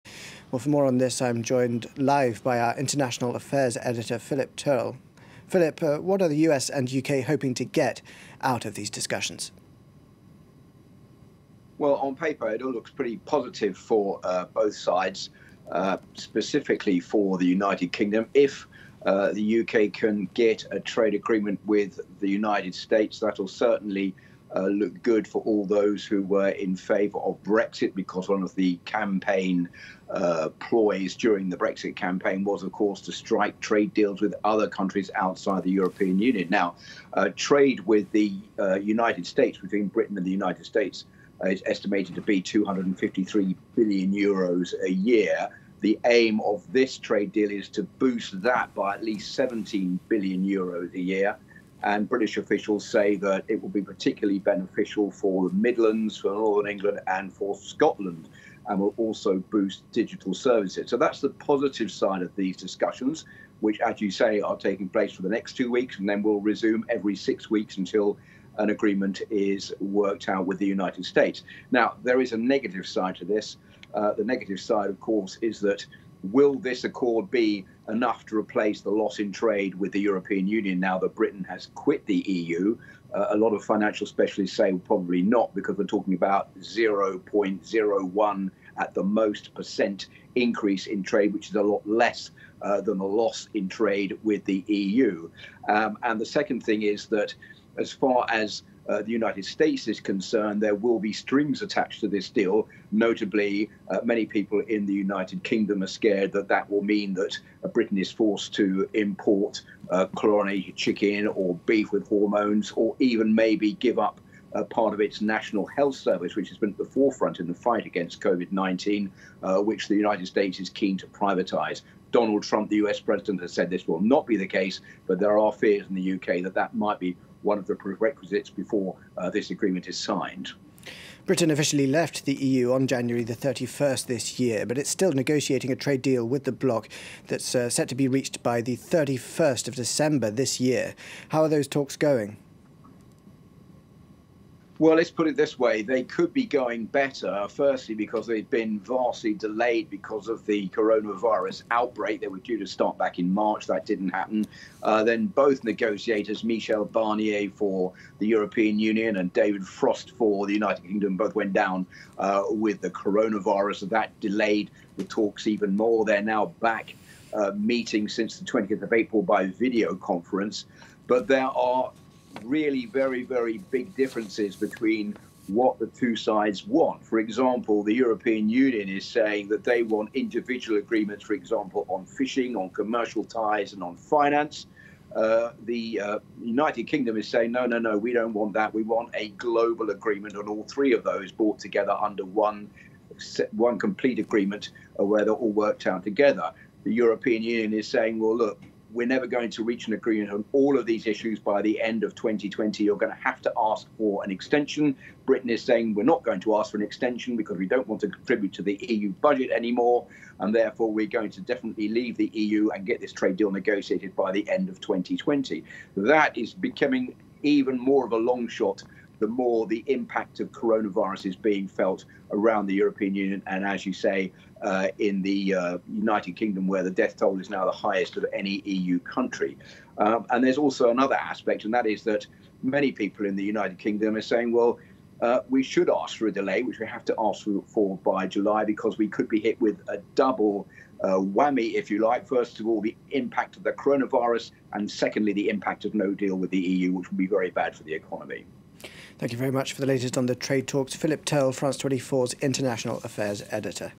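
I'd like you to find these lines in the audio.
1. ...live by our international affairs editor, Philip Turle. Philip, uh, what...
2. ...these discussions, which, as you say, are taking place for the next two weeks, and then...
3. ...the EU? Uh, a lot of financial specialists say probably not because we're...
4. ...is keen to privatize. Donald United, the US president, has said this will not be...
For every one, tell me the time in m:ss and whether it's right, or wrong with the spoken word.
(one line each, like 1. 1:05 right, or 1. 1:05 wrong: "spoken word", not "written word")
1. 0:01 right
2. 1:02 right
3. 1:22 right
4. 2:00 wrong: "Trump", not "United".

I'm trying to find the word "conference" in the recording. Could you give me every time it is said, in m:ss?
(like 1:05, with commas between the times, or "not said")
2:49.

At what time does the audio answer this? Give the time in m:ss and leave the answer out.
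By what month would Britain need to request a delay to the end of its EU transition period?
3:58.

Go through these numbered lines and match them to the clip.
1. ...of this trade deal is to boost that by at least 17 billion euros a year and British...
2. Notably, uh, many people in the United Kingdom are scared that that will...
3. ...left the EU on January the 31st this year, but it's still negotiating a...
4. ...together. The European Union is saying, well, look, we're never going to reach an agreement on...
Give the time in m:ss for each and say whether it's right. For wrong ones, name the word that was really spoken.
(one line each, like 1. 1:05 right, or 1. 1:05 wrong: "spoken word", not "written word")
1. 0:46 right
2. 1:42 right
3. 2:11 right
4. 3:16 right.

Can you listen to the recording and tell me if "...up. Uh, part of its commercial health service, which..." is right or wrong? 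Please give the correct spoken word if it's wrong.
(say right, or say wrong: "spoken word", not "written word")
wrong: "national", not "commercial".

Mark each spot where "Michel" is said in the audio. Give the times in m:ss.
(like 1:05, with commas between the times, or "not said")
2:36.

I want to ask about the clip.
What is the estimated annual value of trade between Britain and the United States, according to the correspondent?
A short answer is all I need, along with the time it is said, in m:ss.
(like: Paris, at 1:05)
253 billion euros, at 0:42.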